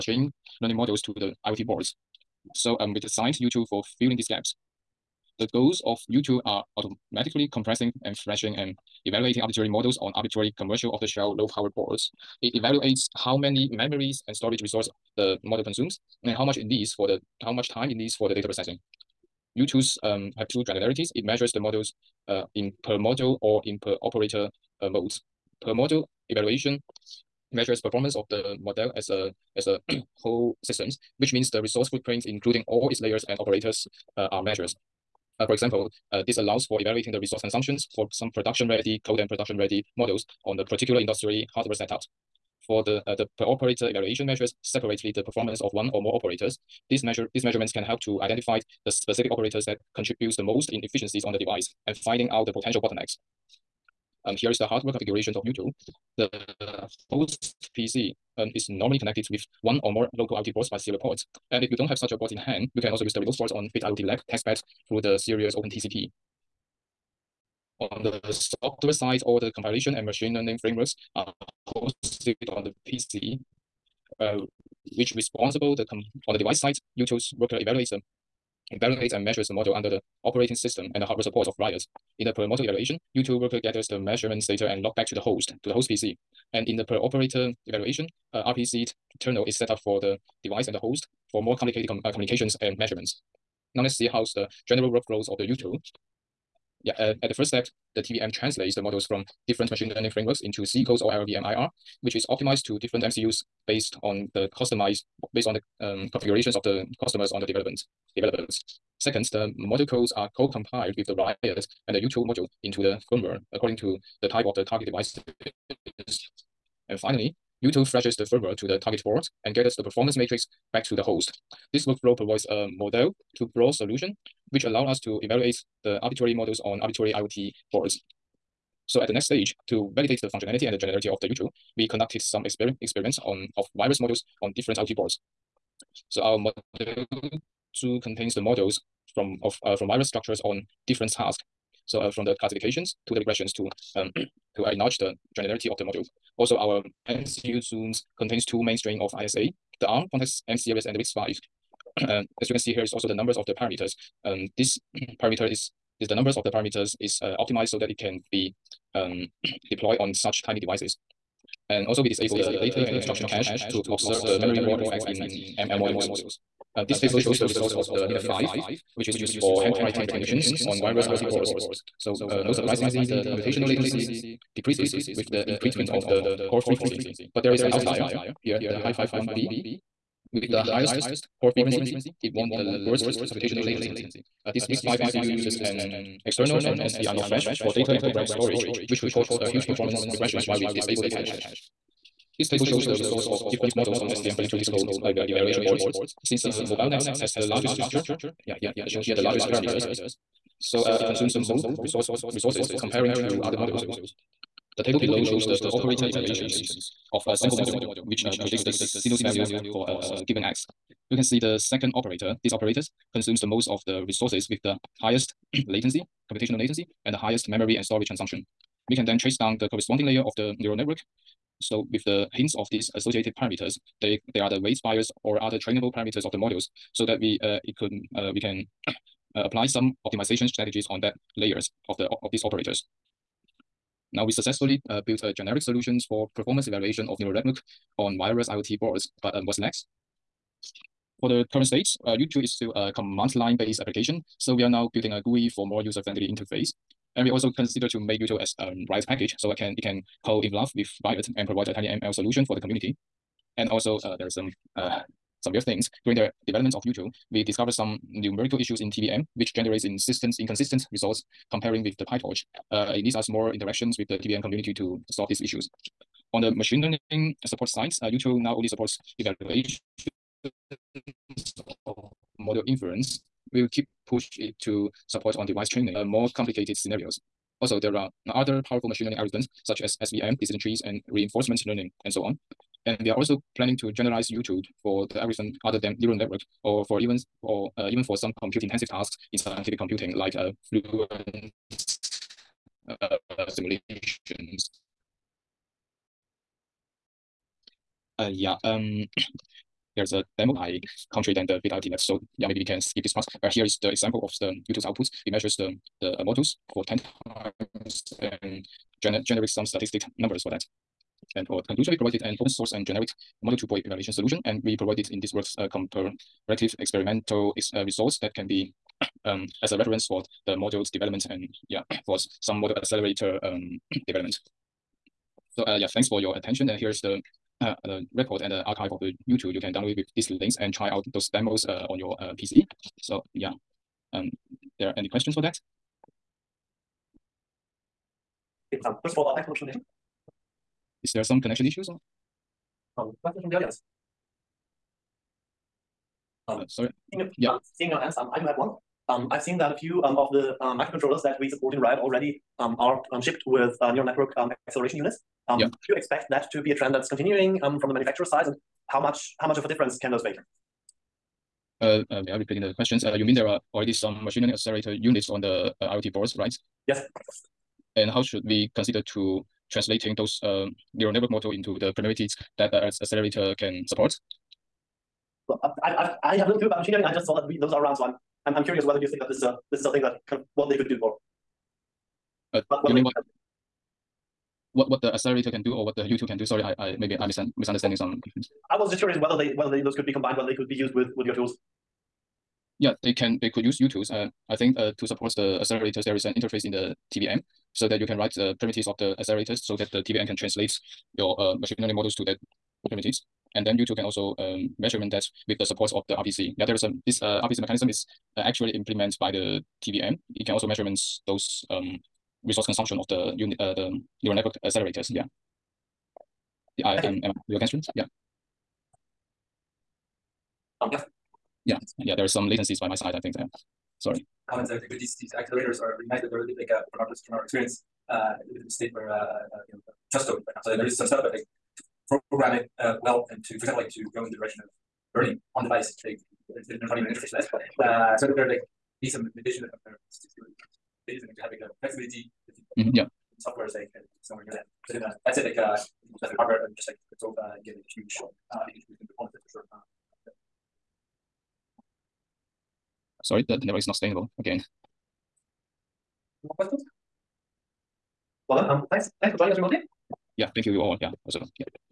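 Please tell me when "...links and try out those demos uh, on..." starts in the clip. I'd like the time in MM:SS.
05:30.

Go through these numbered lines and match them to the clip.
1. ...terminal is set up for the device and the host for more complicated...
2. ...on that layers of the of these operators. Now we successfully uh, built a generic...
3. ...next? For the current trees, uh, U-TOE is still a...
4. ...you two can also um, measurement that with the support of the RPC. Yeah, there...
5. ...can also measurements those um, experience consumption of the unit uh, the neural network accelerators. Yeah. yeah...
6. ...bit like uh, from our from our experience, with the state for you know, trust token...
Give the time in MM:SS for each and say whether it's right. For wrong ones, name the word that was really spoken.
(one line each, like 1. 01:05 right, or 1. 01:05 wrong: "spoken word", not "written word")
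1. 01:29 right
2. 03:50 right
3. 03:59 wrong: "states", not "trees"
4. 06:43 right
5. 06:50 wrong: "resource", not "experience"
6. 07:06 right.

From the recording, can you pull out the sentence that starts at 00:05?
The goals of YouTube are auto Automatically compressing and flashing and evaluating arbitrary models on arbitrary commercial off-the-shelf low-power boards.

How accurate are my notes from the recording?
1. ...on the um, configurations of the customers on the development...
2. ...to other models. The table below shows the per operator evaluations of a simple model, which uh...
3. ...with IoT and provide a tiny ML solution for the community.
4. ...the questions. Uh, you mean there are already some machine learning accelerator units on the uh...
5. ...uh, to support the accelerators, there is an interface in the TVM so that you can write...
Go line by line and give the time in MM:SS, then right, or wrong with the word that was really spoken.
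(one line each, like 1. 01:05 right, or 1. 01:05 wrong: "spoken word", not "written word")
1. 01:45 right
2. 03:23 right
3. 04:10 wrong: "Riot", not "IoT"
4. 06:02 right
5. 06:34 right.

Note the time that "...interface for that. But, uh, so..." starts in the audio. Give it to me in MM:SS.
07:17.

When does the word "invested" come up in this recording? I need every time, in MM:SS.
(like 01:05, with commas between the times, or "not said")
not said.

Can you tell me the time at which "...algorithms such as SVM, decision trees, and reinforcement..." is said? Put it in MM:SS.
04:39.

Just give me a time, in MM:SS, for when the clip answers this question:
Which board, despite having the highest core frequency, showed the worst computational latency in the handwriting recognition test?
02:58.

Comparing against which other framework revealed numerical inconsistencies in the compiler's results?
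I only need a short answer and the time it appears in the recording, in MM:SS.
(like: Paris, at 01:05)
PyTorch, at 04:22.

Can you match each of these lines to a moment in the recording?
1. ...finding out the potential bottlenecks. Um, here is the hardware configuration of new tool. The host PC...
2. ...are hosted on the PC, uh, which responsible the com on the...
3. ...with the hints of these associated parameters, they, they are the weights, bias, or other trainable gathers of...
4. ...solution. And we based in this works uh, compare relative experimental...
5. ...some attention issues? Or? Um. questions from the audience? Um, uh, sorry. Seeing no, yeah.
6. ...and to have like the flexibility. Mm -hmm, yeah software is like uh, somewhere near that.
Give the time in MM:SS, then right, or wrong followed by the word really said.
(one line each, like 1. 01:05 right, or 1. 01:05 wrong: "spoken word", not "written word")
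1. 00:51 right
2. 01:11 right
3. 03:41 wrong: "parameters", not "gathers"
4. 05:14 wrong: "provided", not "based"
5. 05:41 wrong: "connection", not "attention"
6. 07:21 right.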